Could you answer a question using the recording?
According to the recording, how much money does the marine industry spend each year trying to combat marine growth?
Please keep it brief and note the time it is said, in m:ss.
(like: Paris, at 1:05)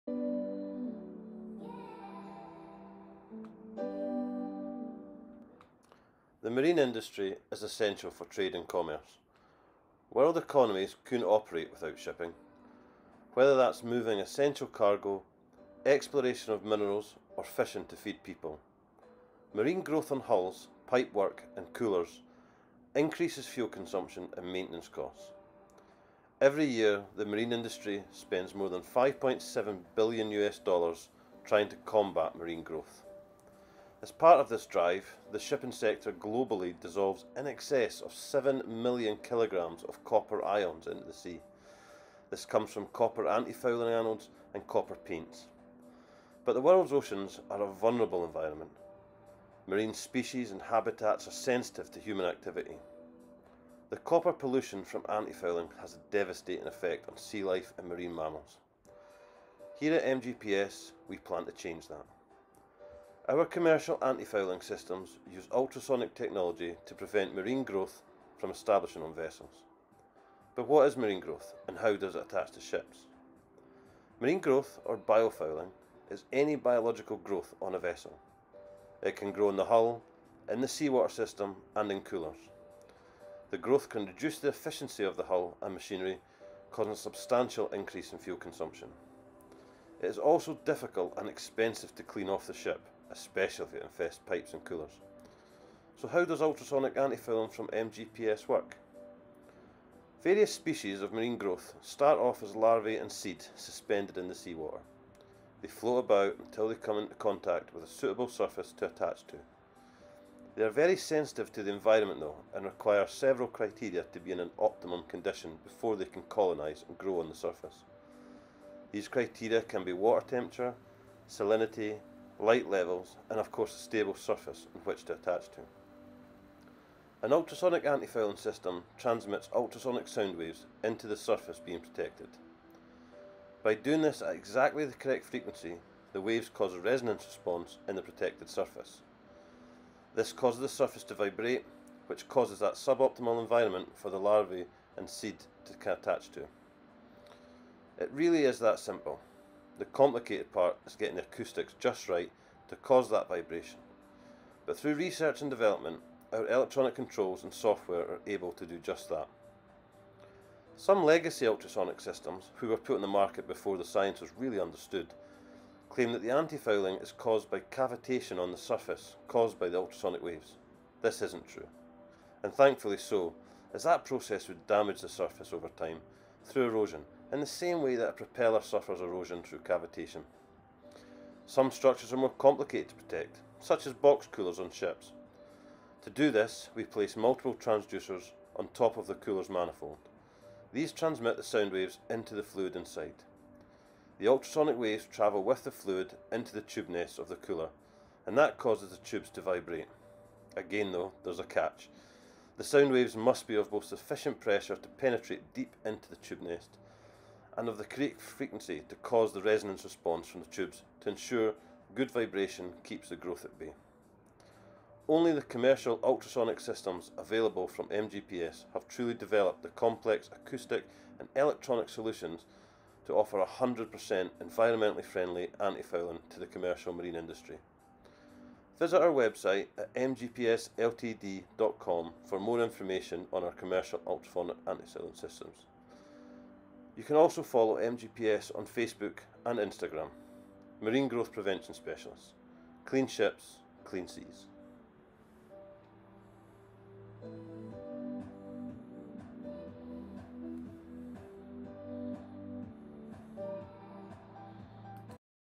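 5.7 billion US dollars, at 0:28.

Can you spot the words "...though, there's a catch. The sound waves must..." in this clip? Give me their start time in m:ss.
3:20.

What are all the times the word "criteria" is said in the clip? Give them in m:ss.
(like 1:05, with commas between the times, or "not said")
1:53, 1:59.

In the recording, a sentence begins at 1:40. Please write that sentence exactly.
Various species of marine growth start off as larvae and seed suspended in the seawater.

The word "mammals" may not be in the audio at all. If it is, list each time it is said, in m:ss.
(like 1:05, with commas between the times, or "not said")
0:58.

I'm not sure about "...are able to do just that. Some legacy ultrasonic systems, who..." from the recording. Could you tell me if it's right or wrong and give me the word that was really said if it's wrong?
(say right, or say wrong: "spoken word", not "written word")
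right.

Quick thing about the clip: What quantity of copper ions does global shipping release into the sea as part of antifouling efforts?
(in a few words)
7 million kilograms.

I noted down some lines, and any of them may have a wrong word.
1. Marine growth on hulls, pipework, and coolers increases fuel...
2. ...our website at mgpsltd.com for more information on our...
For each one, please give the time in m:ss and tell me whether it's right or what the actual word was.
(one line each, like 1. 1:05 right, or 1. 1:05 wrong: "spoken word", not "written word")
1. 0:19 right
2. 3:48 right.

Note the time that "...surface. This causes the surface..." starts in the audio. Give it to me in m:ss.
2:18.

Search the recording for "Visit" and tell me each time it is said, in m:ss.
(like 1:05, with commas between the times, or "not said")
3:48.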